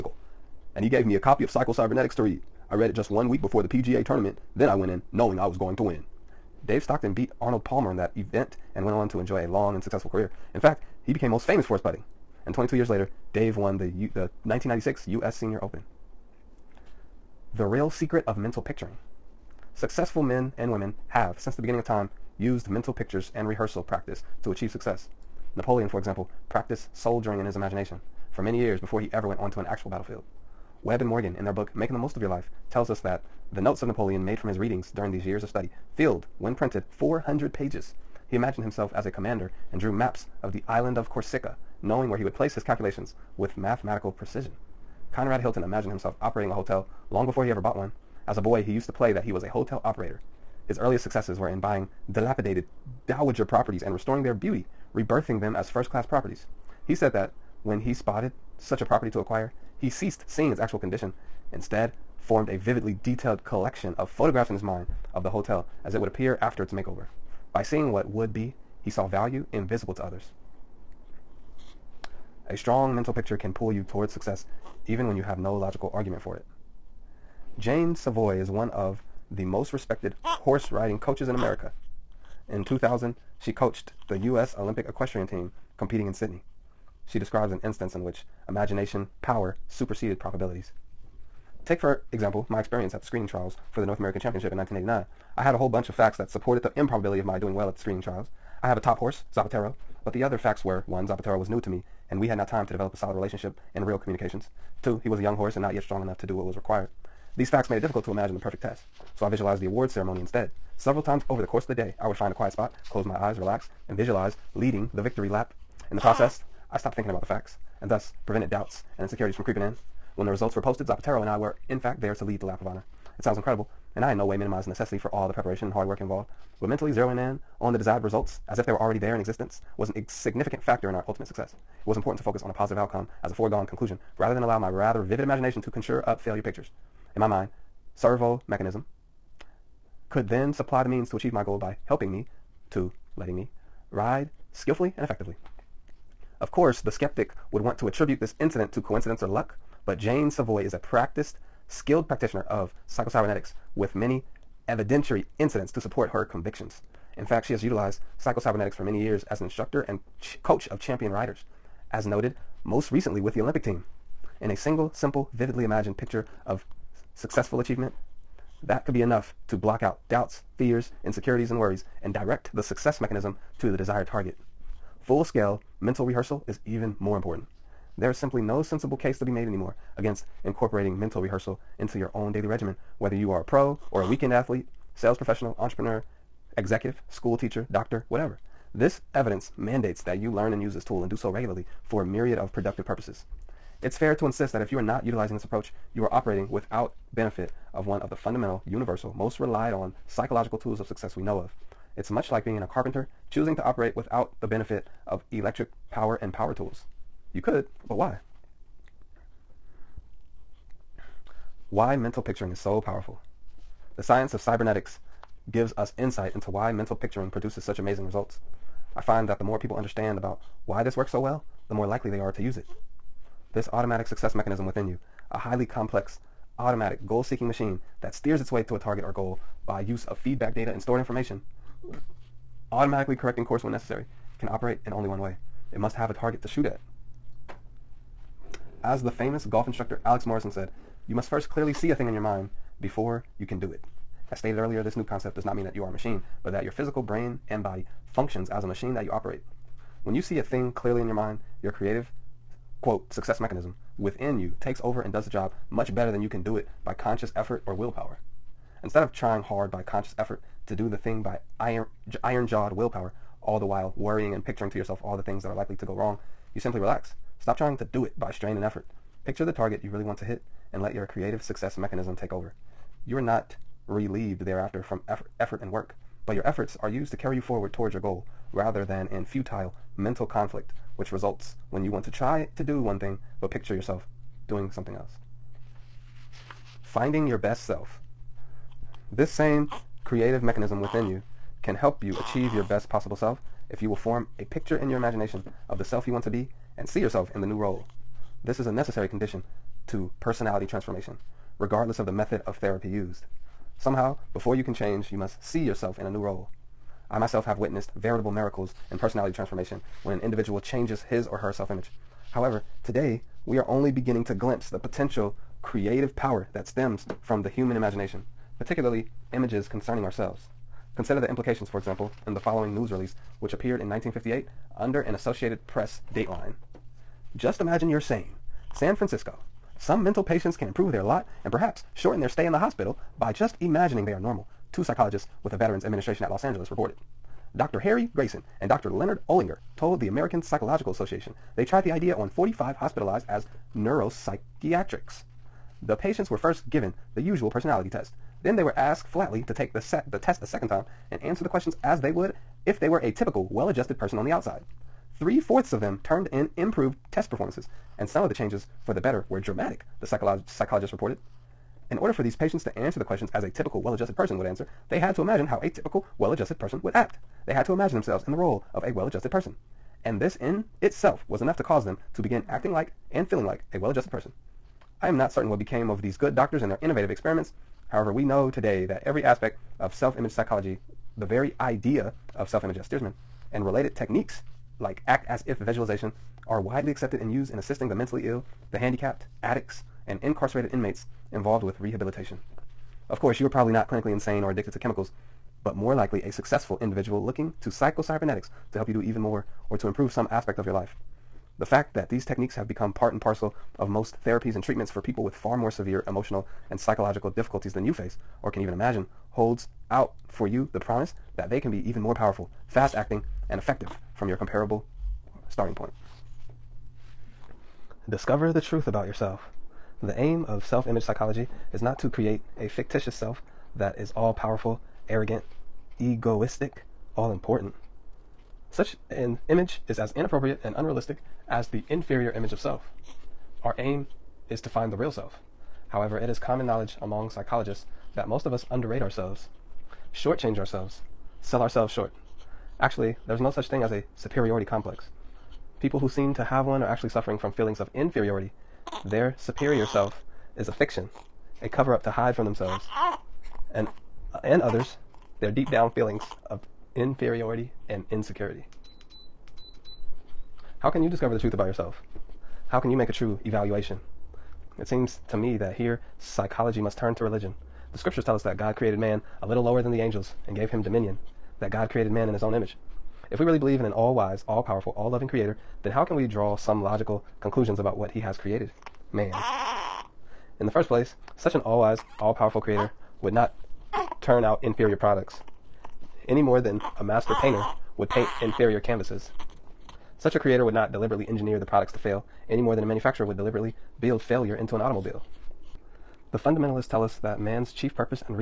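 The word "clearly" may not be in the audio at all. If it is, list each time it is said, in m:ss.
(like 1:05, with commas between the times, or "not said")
4:01, 4:10.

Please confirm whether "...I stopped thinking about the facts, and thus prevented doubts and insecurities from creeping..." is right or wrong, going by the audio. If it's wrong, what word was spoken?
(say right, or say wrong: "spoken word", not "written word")
right.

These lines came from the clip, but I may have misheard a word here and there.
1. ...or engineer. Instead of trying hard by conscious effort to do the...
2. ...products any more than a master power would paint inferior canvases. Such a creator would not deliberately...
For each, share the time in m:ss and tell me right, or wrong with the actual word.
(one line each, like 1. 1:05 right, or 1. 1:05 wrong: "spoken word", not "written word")
1. 4:17 wrong: "willpower", not "engineer"
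2. 8:04 wrong: "painter", not "power".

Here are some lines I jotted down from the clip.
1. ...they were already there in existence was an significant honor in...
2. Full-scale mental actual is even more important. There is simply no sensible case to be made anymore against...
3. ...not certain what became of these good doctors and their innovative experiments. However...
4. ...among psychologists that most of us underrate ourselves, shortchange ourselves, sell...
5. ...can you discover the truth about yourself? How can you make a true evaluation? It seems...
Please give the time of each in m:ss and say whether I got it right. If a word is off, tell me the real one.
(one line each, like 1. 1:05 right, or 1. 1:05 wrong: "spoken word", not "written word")
1. 2:08 wrong: "factor", not "honor"
2. 2:55 wrong: "rehearsal", not "actual"
3. 6:15 right
4. 7:17 right
5. 7:40 right.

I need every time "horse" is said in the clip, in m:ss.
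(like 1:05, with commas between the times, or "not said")
1:20, 1:38, 1:45.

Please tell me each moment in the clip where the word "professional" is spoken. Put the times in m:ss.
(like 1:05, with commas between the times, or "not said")
3:05.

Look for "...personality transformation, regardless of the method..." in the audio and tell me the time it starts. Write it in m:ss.
5:00.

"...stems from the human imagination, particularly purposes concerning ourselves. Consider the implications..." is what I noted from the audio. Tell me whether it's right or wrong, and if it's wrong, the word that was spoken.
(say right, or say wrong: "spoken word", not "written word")
wrong: "images", not "purposes".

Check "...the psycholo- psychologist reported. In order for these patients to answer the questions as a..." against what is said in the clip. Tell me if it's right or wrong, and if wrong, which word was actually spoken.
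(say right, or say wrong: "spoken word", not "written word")
right.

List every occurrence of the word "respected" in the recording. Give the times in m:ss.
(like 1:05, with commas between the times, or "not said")
1:19.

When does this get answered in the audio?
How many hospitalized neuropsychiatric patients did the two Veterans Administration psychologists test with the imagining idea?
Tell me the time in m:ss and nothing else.
5:42.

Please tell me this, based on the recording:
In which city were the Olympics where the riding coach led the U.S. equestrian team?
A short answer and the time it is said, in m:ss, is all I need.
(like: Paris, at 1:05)
Sydney, at 1:26.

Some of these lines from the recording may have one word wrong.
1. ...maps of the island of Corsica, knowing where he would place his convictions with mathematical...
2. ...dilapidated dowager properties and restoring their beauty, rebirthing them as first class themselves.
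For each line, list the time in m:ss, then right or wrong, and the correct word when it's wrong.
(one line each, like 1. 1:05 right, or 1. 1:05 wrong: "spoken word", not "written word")
1. 0:39 wrong: "calculations", not "convictions"
2. 0:52 wrong: "properties", not "themselves".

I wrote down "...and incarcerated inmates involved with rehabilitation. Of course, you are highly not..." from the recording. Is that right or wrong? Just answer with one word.
wrong.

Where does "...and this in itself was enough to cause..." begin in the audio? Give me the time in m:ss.
6:10.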